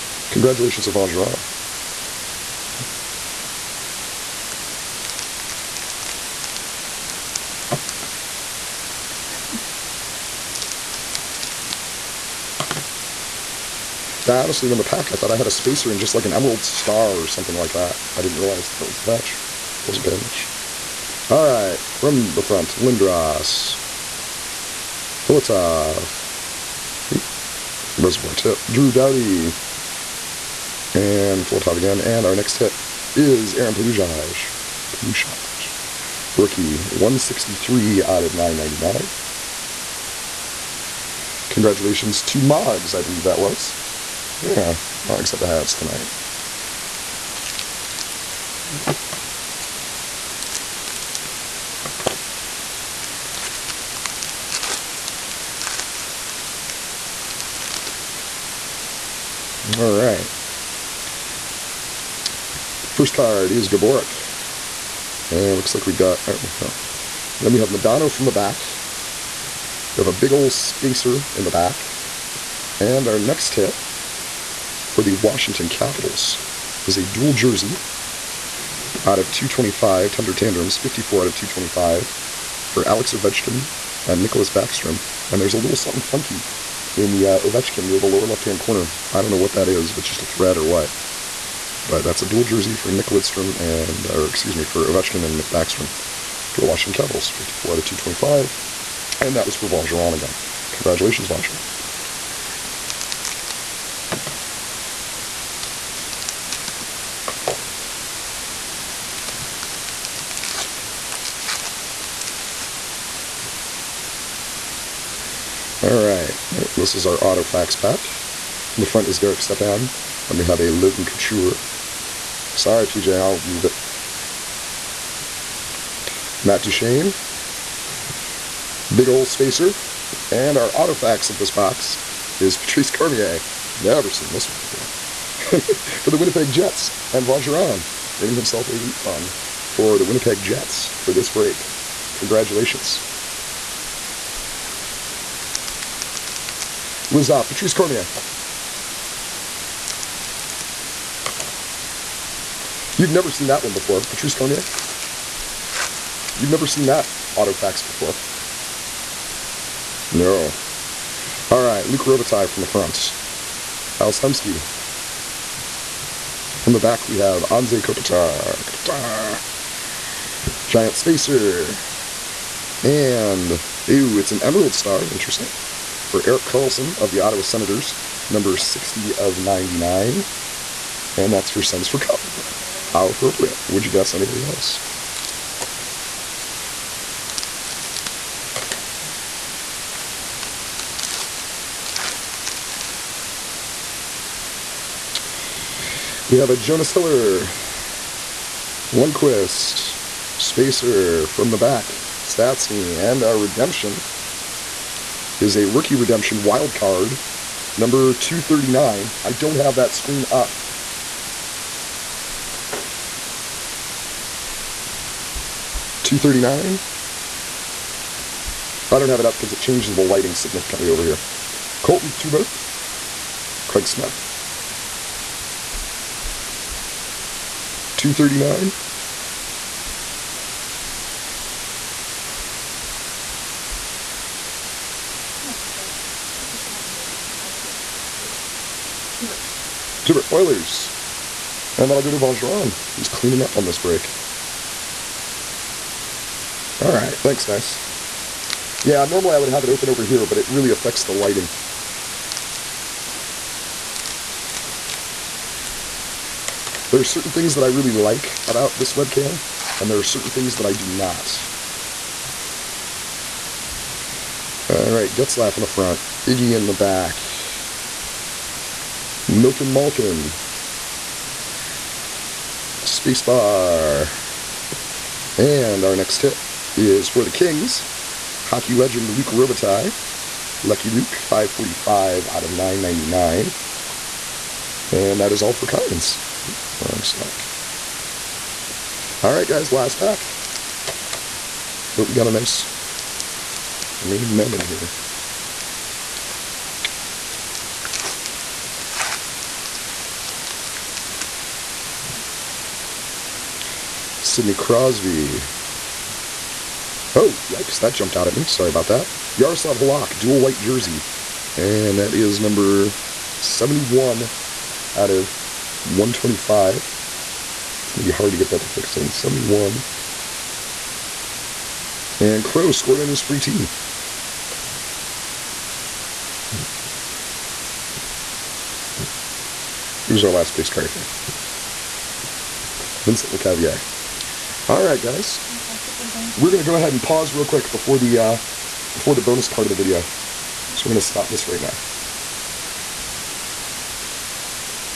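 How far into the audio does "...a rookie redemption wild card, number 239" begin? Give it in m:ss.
3:25.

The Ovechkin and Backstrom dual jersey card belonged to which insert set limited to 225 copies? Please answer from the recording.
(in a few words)
Thunder Tandems.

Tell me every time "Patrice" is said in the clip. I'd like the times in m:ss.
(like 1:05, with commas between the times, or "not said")
2:12, 2:27, 2:34.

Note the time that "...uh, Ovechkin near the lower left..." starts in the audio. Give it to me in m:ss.
1:27.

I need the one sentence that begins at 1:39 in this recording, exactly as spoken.
And that was for Von Geron again.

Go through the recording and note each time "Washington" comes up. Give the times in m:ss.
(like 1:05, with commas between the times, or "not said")
1:15, 1:36.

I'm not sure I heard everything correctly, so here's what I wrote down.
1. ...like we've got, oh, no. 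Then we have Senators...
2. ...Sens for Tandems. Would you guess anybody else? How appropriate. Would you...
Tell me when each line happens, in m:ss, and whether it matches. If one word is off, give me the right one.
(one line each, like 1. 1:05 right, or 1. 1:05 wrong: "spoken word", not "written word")
1. 1:05 wrong: "Modano", not "Senators"
2. 3:01 wrong: "Cup", not "Tandems".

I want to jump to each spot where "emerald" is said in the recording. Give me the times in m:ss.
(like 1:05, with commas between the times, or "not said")
0:16, 2:54.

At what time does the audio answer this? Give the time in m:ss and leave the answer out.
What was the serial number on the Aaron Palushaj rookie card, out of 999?
0:36.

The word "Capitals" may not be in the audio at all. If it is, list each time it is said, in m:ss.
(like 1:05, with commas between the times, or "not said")
1:15, 1:37.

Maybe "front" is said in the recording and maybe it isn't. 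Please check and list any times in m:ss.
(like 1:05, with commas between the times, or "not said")
0:22, 1:58, 2:42, 4:25.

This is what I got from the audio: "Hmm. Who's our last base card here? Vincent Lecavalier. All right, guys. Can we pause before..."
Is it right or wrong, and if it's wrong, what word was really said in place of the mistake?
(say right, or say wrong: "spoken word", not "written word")
right.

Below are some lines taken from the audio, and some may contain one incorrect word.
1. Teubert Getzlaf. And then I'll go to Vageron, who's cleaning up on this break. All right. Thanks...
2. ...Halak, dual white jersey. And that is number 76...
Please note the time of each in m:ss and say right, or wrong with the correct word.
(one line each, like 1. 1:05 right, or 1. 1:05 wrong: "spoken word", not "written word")
1. 4:00 wrong: "Oilers", not "Getzlaf"
2. 5:09 wrong: "71", not "76".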